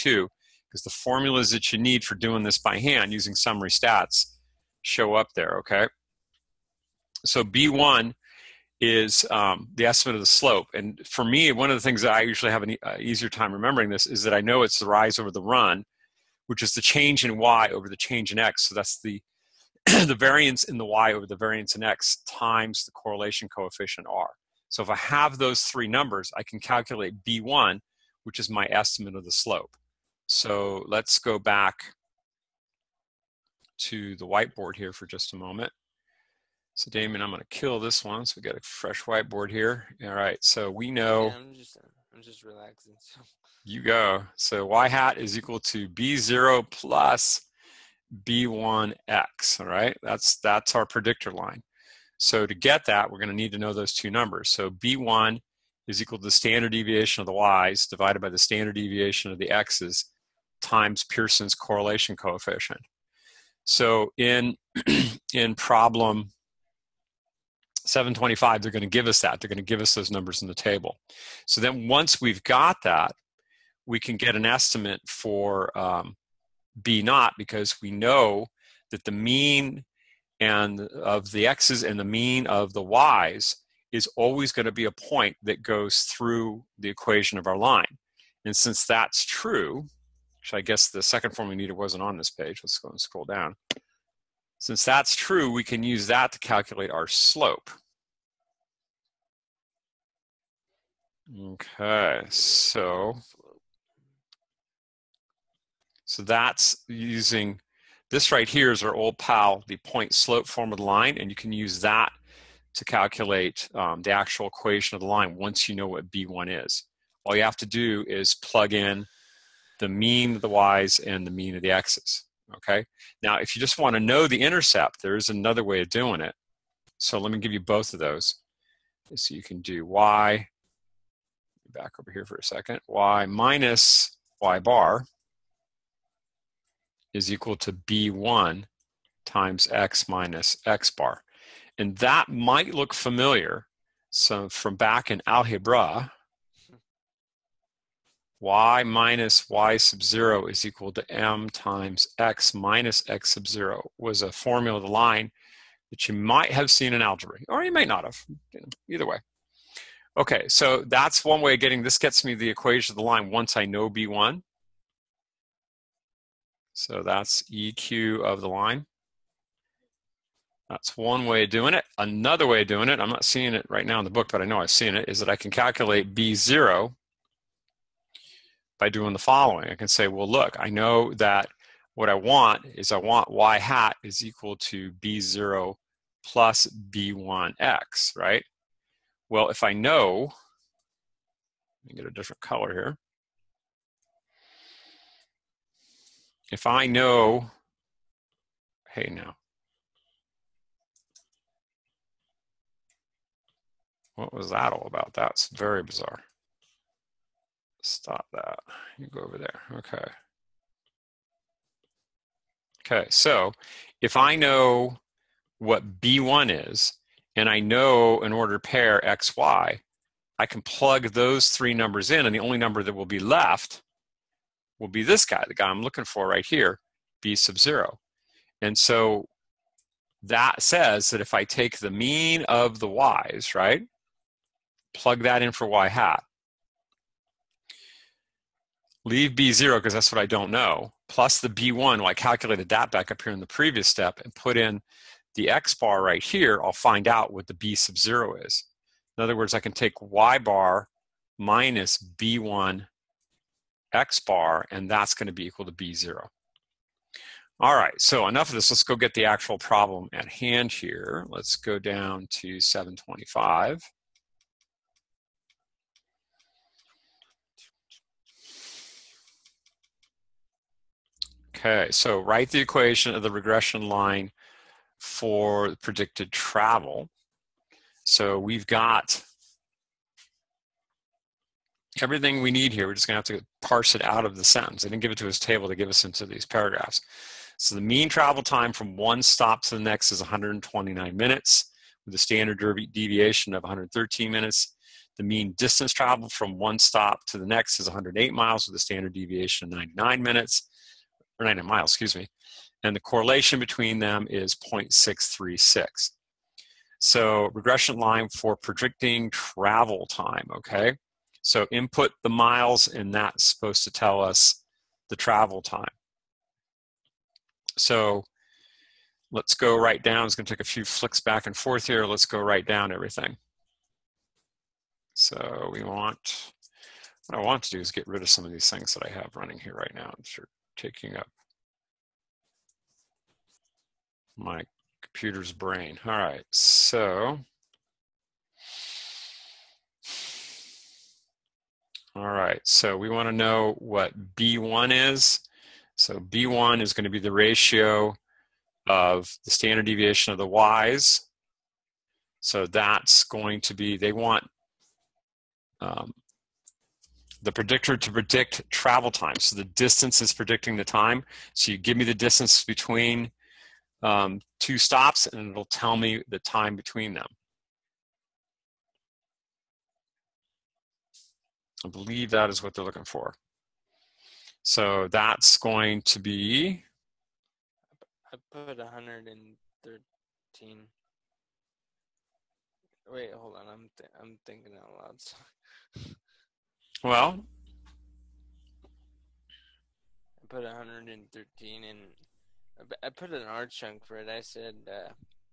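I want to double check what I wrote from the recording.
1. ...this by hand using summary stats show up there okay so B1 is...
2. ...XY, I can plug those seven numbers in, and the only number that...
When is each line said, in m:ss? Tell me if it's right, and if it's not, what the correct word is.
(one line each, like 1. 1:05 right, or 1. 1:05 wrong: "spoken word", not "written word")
1. 0:02 right
2. 3:39 wrong: "three", not "seven".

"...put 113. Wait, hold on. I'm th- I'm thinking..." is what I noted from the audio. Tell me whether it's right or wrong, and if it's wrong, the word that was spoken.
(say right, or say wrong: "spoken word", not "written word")
right.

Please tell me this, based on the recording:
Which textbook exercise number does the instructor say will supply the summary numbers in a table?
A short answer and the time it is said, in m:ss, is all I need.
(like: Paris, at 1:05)
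725, at 1:05.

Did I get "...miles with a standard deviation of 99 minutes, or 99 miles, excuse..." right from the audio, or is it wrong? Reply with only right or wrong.
right.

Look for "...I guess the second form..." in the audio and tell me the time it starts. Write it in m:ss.
1:30.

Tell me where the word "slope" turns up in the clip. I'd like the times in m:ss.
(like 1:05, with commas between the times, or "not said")
0:10, 0:29, 1:37, 1:50.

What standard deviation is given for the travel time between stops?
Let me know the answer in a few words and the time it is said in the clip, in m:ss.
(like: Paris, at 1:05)
113 minutes, at 4:53.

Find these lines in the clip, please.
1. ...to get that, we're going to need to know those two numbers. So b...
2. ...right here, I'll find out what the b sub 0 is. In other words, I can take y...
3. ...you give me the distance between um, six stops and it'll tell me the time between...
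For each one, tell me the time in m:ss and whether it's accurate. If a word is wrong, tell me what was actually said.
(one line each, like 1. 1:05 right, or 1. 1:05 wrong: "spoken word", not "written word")
1. 0:52 right
2. 4:06 right
3. 6:01 wrong: "two", not "six".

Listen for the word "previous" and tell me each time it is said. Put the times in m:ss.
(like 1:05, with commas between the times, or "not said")
4:03.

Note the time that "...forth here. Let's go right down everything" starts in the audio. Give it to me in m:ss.
5:21.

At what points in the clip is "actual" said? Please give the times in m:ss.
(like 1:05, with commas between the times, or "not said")
1:54, 4:19.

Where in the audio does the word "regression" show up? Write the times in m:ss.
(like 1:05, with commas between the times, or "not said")
4:33, 5:07.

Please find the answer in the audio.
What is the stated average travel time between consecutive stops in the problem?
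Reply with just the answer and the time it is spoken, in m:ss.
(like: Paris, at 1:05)
129 minutes, at 4:50.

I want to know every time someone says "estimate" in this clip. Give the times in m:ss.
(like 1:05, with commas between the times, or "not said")
0:09, 0:28, 1:14.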